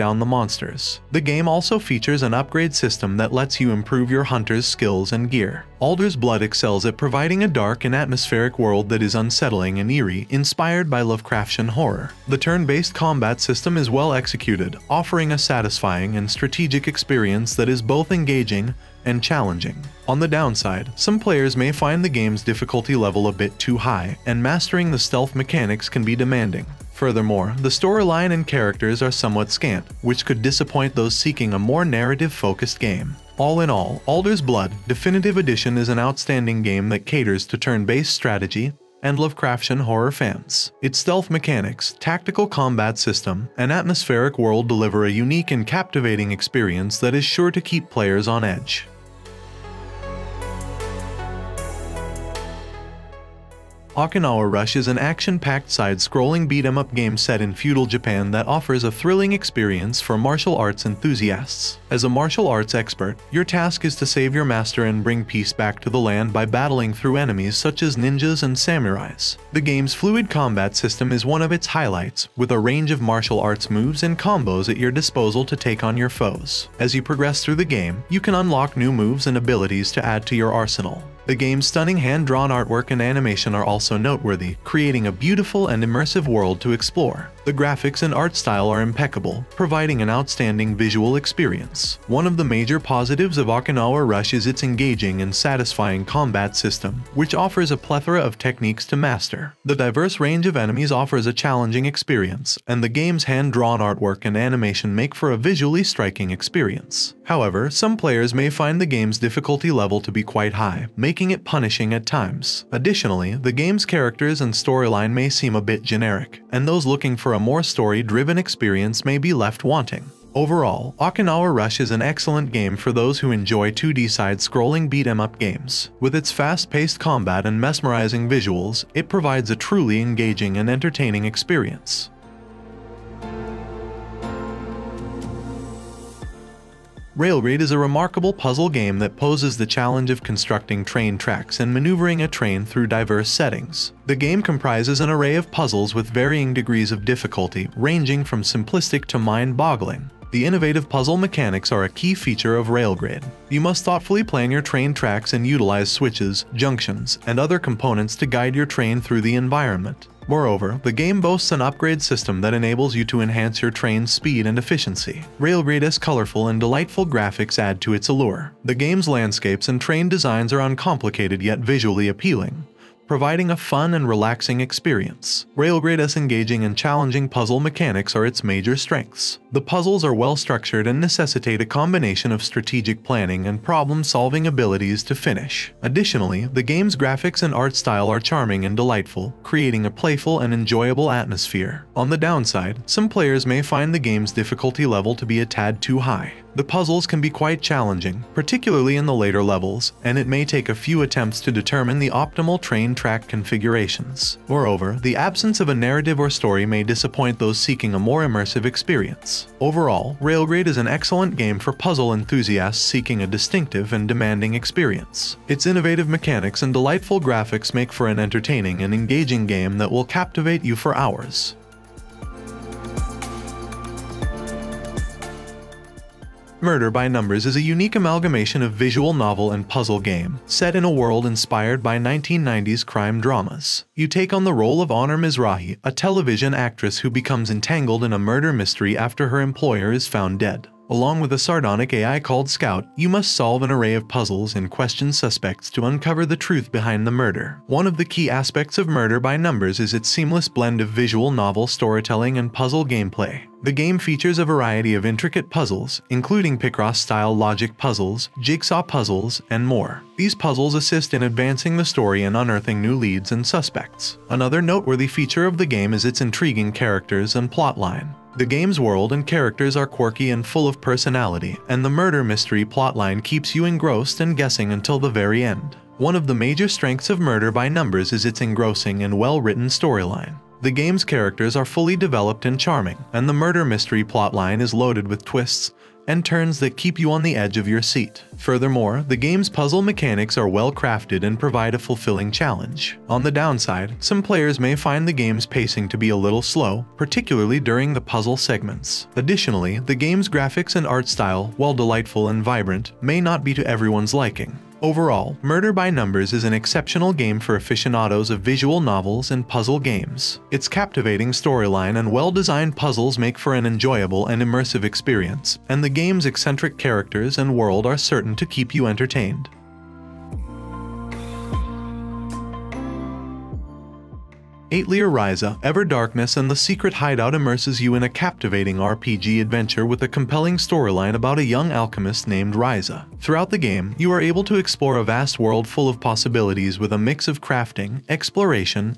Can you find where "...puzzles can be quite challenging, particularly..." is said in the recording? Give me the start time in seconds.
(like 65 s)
196 s.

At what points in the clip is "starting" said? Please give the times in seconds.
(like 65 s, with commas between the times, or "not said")
not said.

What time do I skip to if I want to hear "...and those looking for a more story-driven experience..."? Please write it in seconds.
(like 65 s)
116 s.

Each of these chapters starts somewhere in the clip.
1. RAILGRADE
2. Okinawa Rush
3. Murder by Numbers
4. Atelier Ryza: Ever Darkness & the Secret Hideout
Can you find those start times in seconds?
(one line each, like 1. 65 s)
1. 136 s
2. 53 s
3. 226 s
4. 324 s.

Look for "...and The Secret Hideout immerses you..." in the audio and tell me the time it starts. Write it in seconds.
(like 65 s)
326 s.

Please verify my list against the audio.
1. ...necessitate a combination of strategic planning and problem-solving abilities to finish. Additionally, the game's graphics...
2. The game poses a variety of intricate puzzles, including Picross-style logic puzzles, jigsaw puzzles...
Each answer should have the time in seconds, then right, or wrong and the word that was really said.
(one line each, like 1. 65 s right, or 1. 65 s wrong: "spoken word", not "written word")
1. 180 s right
2. 253 s wrong: "features", not "poses".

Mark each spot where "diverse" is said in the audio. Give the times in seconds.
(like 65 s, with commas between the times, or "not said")
99 s, 142 s.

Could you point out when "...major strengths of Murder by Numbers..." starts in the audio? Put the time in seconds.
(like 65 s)
276 s.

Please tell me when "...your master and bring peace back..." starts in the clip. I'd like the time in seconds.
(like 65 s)
64 s.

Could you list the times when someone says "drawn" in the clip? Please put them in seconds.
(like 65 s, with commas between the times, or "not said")
81 s, 103 s.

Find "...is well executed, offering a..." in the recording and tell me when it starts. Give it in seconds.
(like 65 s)
13 s.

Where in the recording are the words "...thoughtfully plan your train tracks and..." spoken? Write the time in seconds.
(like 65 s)
153 s.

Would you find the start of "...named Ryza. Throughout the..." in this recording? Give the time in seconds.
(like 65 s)
332 s.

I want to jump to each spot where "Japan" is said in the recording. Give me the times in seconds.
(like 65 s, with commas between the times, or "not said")
57 s.